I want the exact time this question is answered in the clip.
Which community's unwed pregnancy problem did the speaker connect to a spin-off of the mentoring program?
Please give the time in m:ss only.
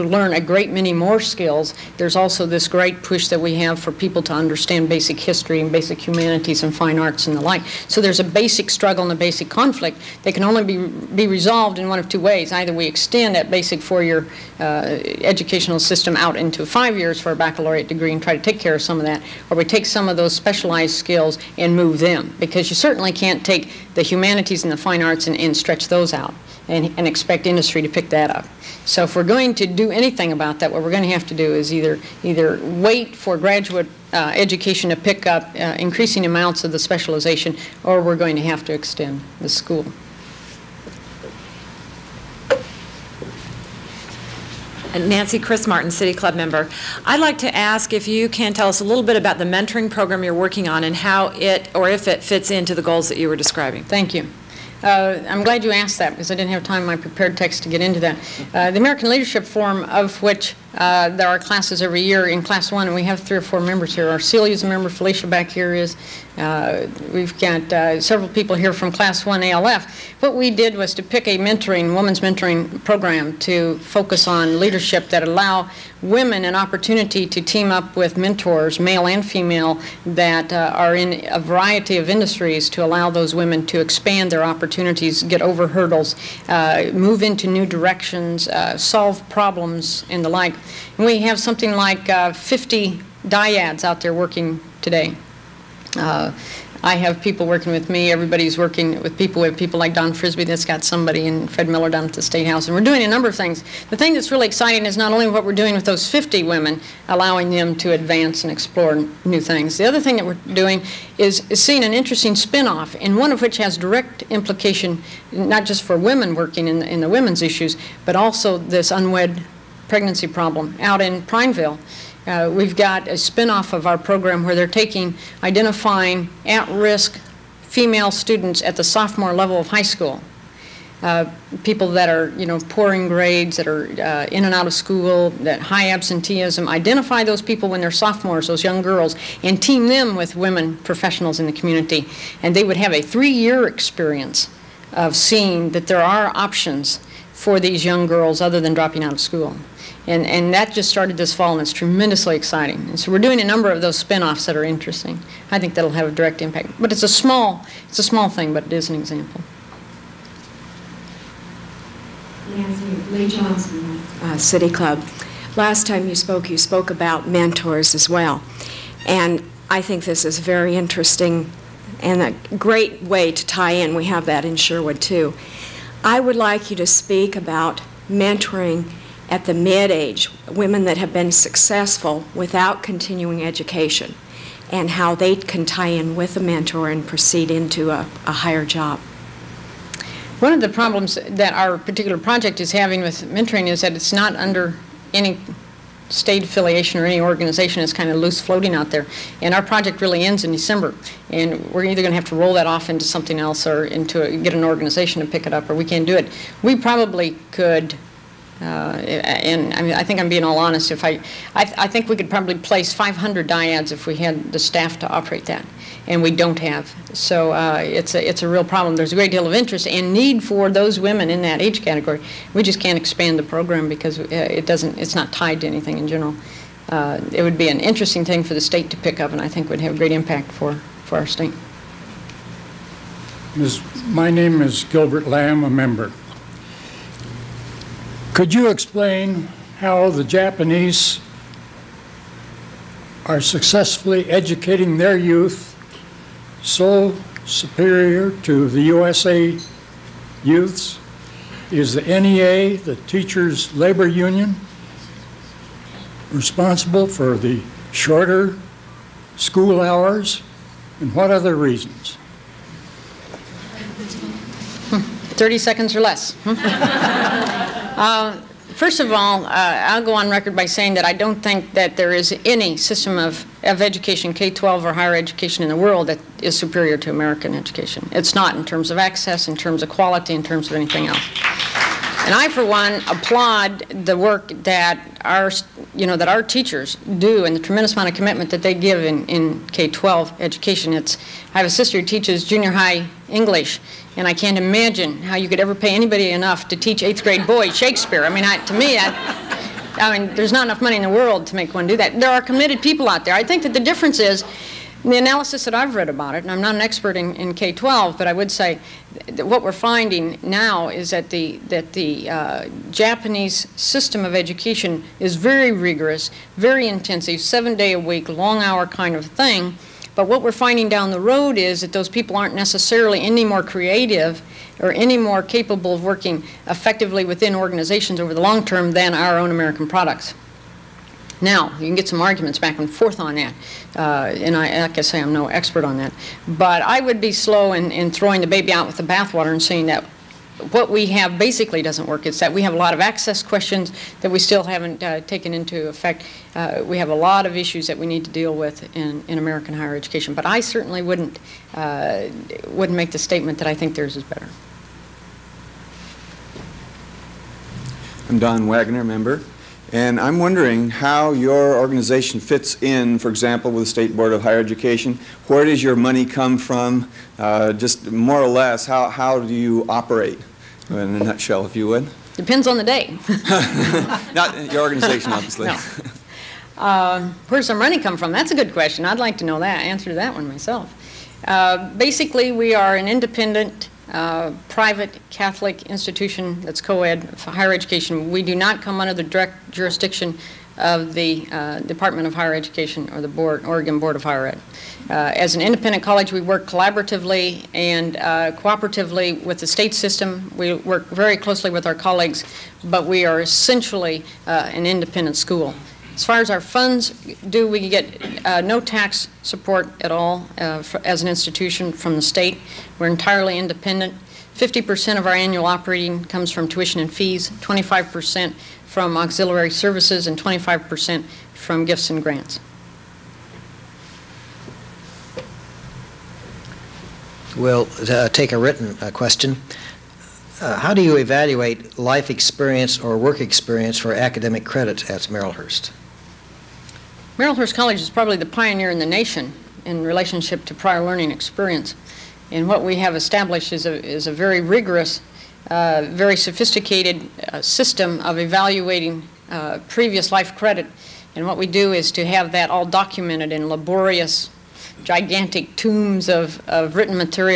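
2:01.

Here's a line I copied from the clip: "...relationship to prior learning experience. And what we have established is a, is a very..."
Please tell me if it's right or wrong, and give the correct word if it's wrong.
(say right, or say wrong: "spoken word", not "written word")
right.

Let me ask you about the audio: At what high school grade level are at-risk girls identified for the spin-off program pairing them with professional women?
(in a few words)
sophomore.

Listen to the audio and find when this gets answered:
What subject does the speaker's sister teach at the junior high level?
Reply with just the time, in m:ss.
4:53.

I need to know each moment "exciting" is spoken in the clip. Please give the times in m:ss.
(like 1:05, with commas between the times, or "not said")
1:44, 2:32.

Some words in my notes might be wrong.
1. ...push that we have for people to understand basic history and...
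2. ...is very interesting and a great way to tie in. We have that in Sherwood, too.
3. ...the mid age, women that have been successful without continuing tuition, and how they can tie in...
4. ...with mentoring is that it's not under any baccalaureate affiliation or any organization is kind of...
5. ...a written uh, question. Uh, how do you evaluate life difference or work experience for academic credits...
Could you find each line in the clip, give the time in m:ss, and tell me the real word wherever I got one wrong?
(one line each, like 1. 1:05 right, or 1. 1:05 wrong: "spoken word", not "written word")
1. 0:03 right
2. 2:50 right
3. 2:59 wrong: "education", not "tuition"
4. 3:13 wrong: "state", not "baccalaureate"
5. 7:08 wrong: "experience", not "difference".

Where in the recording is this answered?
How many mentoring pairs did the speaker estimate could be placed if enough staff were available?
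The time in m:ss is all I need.
3:32.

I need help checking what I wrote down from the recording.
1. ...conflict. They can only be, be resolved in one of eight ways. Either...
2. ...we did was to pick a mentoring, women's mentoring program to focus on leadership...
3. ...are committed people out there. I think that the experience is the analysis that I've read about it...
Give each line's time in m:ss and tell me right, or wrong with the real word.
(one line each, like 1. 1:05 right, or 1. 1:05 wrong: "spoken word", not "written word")
1. 0:09 wrong: "two", not "eight"
2. 1:10 right
3. 5:02 wrong: "difference", not "experience".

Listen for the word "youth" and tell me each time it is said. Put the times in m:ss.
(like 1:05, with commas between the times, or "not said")
4:05, 4:10.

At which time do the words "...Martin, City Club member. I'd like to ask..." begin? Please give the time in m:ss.
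0:45.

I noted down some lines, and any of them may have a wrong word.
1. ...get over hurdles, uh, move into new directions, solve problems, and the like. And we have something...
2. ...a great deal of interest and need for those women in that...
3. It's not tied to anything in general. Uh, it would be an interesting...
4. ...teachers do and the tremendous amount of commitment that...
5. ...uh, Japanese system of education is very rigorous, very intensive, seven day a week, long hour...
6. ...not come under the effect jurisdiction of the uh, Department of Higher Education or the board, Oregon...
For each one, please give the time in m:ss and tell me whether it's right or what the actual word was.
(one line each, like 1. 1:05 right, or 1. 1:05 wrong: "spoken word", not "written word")
1. 1:25 right
2. 3:39 right
3. 3:44 right
4. 4:46 right
5. 5:12 right
6. 6:28 wrong: "direct", not "effect".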